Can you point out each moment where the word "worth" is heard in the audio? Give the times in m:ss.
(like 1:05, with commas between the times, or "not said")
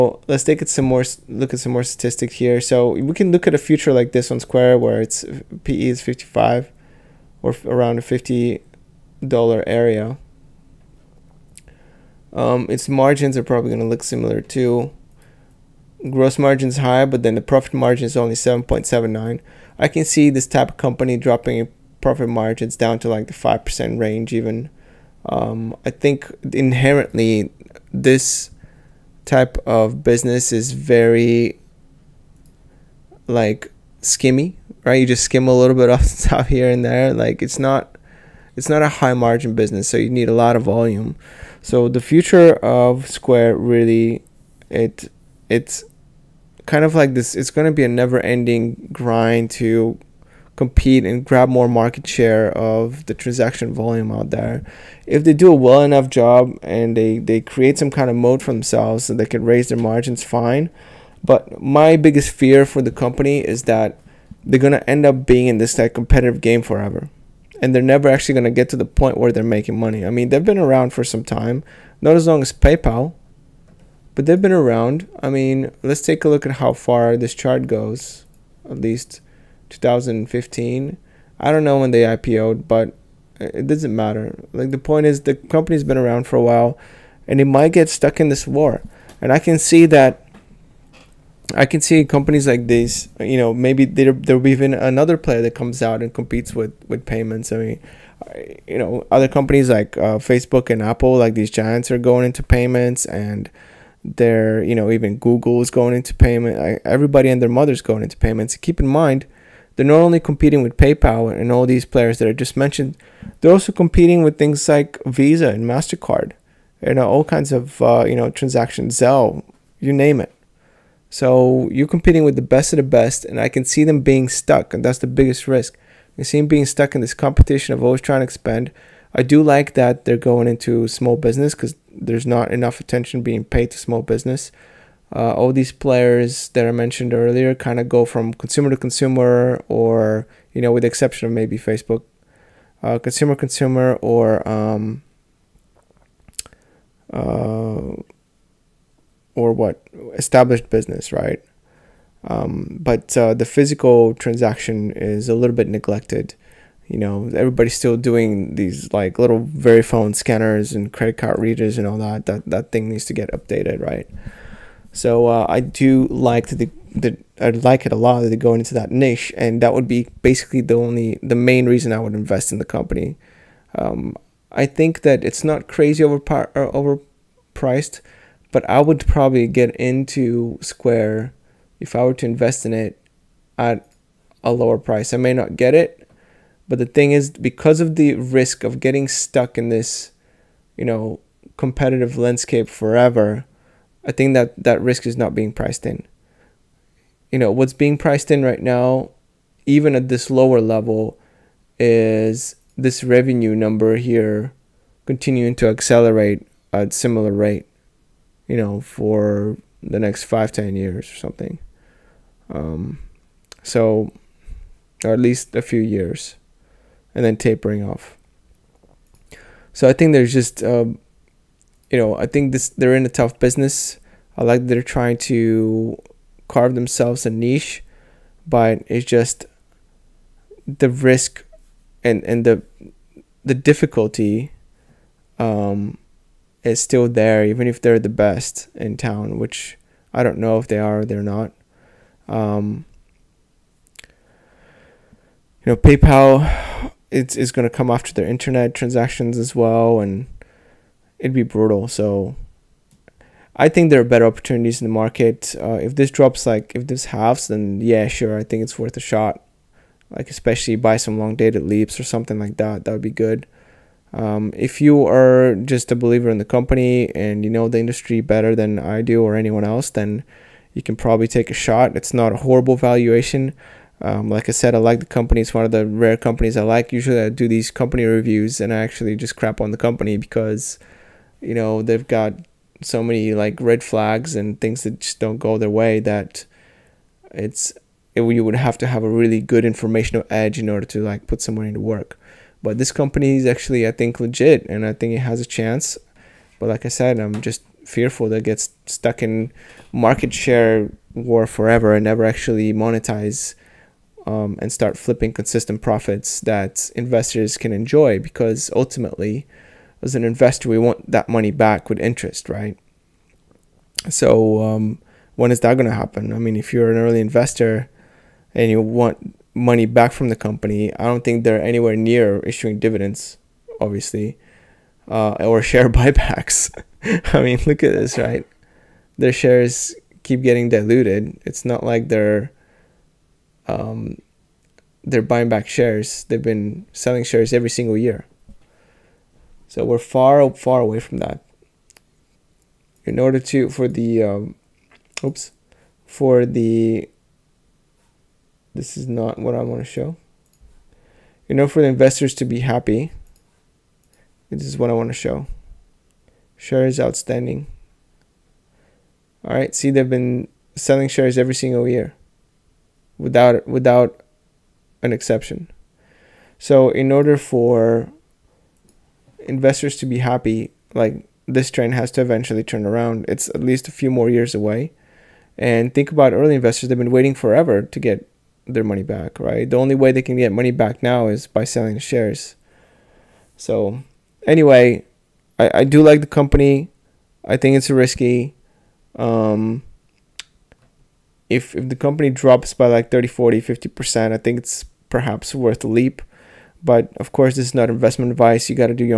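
4:18, 6:35.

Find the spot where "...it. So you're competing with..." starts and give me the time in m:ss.
2:00.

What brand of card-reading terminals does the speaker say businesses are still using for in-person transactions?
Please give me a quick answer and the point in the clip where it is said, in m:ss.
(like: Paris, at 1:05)
Verifone, at 2:39.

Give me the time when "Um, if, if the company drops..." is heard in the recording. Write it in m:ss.
6:29.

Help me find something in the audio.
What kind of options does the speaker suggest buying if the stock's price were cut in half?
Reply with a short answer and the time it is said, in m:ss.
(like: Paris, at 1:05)
long dated LEAPS, at 4:21.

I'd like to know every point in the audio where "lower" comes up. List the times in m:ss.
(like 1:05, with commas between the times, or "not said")
3:04, 3:20.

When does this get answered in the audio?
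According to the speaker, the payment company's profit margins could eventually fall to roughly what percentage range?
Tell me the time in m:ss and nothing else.
0:23.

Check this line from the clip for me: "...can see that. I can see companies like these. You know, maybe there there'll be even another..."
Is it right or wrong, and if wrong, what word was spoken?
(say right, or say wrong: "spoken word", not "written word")
right.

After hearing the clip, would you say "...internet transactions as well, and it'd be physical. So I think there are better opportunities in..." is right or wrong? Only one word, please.
wrong.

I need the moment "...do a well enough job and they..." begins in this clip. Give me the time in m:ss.
0:55.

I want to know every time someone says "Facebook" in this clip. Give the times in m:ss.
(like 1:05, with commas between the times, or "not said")
1:40, 2:21.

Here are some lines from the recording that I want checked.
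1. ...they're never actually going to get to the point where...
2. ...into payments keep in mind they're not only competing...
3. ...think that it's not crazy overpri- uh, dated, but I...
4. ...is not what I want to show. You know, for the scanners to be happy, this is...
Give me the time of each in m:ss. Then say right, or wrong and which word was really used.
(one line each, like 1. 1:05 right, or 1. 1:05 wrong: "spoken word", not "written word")
1. 1:07 right
2. 1:48 right
3. 2:54 wrong: "overpriced", not "dated"
4. 5:48 wrong: "investors", not "scanners".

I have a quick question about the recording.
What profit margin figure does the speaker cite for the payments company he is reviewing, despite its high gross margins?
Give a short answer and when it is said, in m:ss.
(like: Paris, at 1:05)
7.79, at 0:18.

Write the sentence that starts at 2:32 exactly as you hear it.
Um, but uh, the physical transaction is a little bit neglected.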